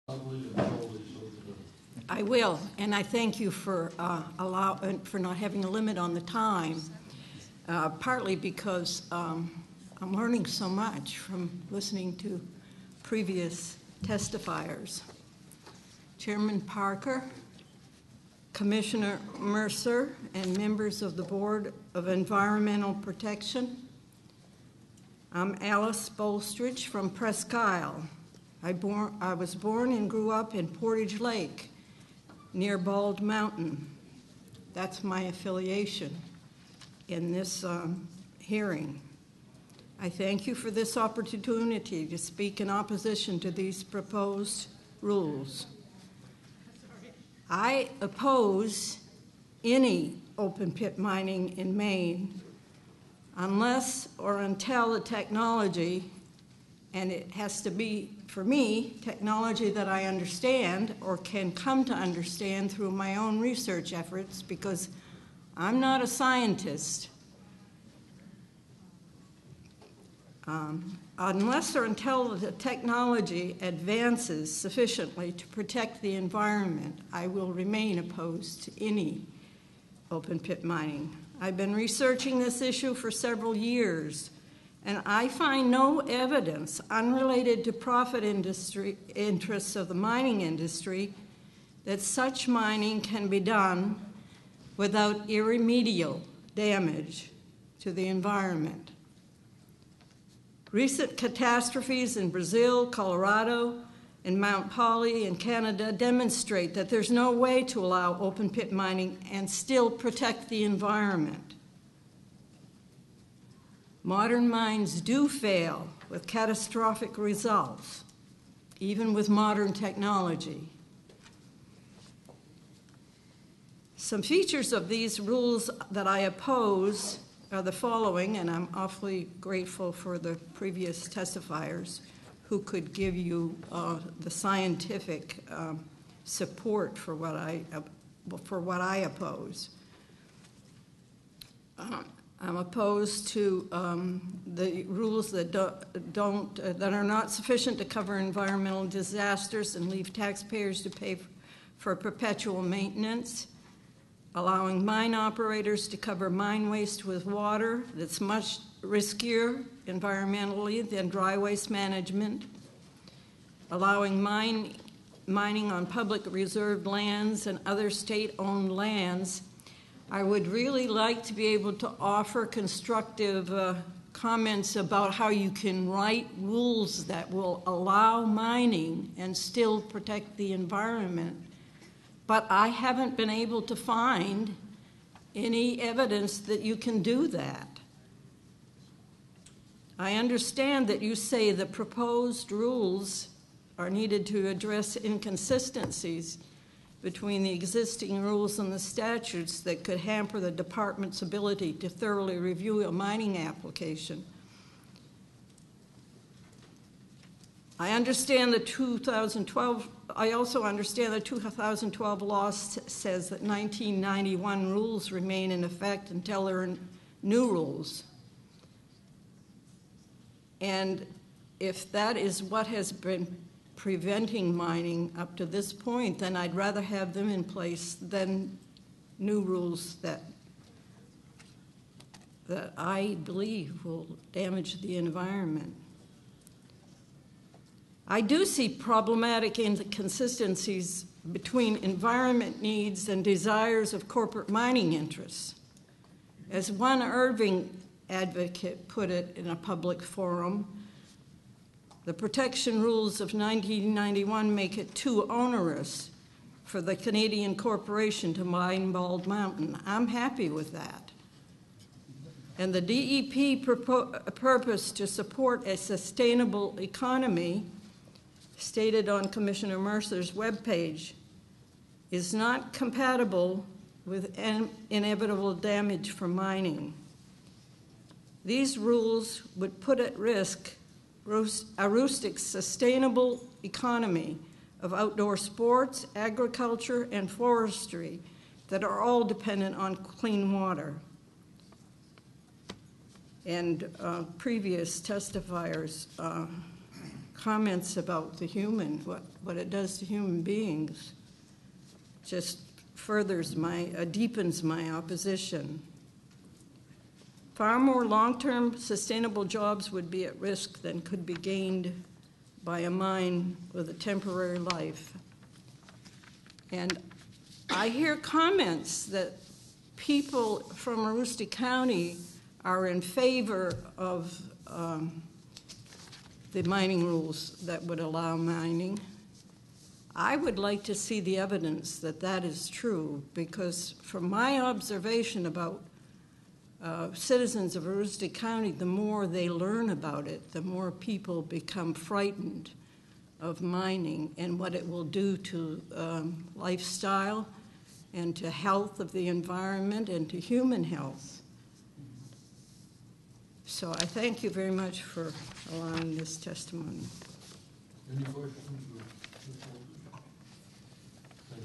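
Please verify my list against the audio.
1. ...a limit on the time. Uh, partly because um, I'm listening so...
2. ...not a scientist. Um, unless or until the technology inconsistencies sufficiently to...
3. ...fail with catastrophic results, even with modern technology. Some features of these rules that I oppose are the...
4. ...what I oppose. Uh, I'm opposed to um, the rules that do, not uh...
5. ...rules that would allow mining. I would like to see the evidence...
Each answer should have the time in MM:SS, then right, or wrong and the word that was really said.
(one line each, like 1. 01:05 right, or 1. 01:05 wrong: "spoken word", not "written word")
1. 00:05 wrong: "learning", not "listening"
2. 01:05 wrong: "advances", not "inconsistencies"
3. 01:55 right
4. 02:18 right
5. 05:27 right.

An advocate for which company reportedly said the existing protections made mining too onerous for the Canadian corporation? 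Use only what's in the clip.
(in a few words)
Irving.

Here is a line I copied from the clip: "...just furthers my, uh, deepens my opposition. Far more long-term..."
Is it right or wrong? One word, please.
right.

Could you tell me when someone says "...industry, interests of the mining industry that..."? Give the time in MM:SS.
01:28.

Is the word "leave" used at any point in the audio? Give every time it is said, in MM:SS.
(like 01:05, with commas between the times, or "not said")
02:29.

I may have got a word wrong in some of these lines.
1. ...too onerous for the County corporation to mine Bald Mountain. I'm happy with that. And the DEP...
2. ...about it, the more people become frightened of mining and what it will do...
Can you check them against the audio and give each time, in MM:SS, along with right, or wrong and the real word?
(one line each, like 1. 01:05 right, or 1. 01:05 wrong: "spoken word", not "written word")
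1. 04:14 wrong: "Canadian", not "County"
2. 05:39 right.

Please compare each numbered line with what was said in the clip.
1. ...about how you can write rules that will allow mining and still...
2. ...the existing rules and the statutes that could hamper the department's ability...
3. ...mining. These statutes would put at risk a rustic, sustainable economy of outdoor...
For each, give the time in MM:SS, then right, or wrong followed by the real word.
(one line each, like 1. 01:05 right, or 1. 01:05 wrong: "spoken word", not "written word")
1. 02:54 right
2. 03:17 right
3. 04:36 wrong: "rules", not "statutes".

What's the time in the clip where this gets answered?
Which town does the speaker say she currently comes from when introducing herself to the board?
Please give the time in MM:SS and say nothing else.
00:27.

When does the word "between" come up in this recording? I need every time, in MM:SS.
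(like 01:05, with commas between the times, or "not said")
03:17, 04:01.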